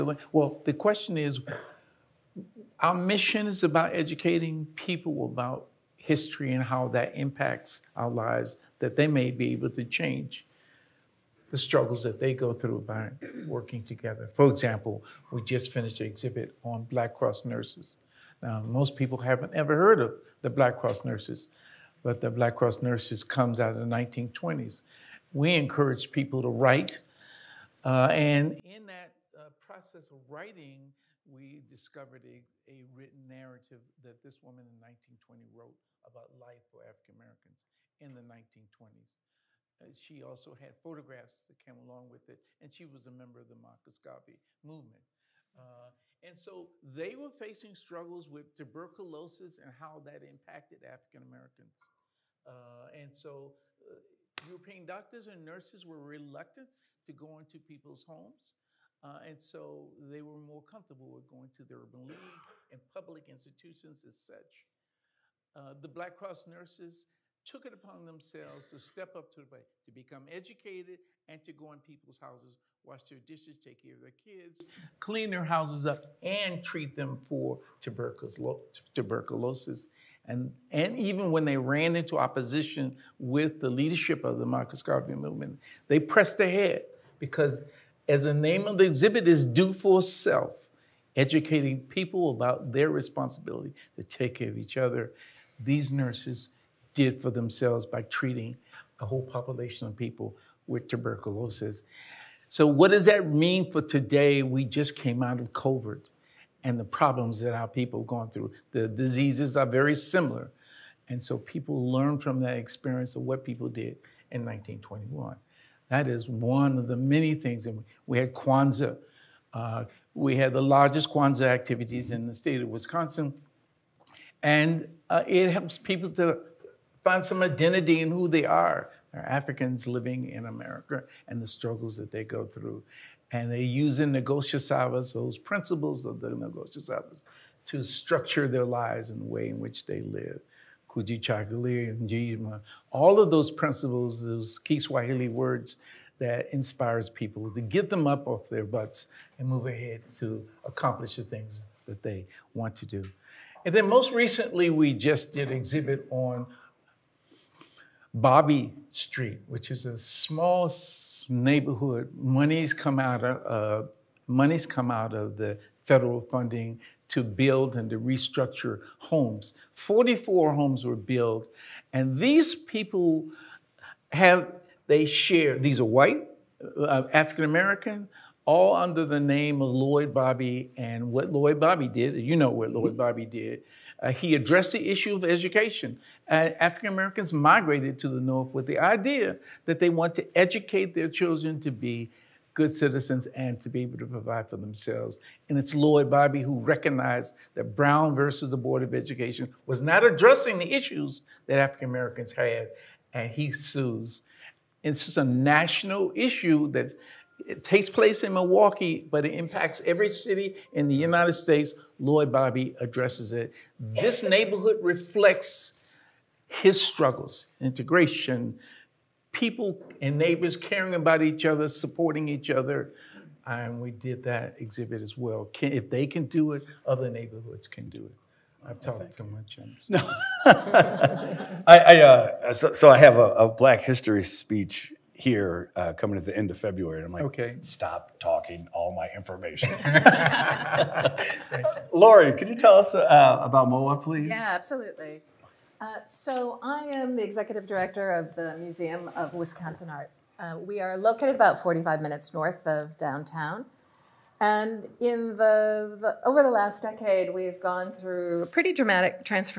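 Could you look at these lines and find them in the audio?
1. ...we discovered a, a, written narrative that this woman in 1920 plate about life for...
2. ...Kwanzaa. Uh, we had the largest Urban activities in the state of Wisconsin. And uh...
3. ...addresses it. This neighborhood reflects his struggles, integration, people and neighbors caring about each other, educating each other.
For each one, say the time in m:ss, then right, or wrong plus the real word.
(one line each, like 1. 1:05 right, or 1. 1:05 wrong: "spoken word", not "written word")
1. 0:31 wrong: "wrote", not "plate"
2. 1:58 wrong: "Kwanzaa", not "Urban"
3. 3:32 wrong: "supporting", not "educating".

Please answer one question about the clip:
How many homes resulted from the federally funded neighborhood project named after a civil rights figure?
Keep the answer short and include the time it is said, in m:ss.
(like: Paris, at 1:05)
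44, at 2:49.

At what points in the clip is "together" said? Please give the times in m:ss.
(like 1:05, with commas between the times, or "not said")
0:13.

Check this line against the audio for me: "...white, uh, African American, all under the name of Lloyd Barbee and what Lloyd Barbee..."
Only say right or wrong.
right.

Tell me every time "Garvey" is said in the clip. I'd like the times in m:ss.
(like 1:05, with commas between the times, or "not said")
0:43, 1:24.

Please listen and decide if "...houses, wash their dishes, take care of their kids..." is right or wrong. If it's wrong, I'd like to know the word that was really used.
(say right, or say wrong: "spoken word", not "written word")
right.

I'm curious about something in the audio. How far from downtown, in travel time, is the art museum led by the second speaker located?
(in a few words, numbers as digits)
45 minutes.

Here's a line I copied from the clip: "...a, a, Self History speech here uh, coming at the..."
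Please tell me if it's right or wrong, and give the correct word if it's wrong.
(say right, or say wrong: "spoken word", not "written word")
wrong: "Black", not "Self".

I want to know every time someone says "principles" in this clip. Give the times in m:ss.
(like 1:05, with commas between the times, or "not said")
2:15, 2:23.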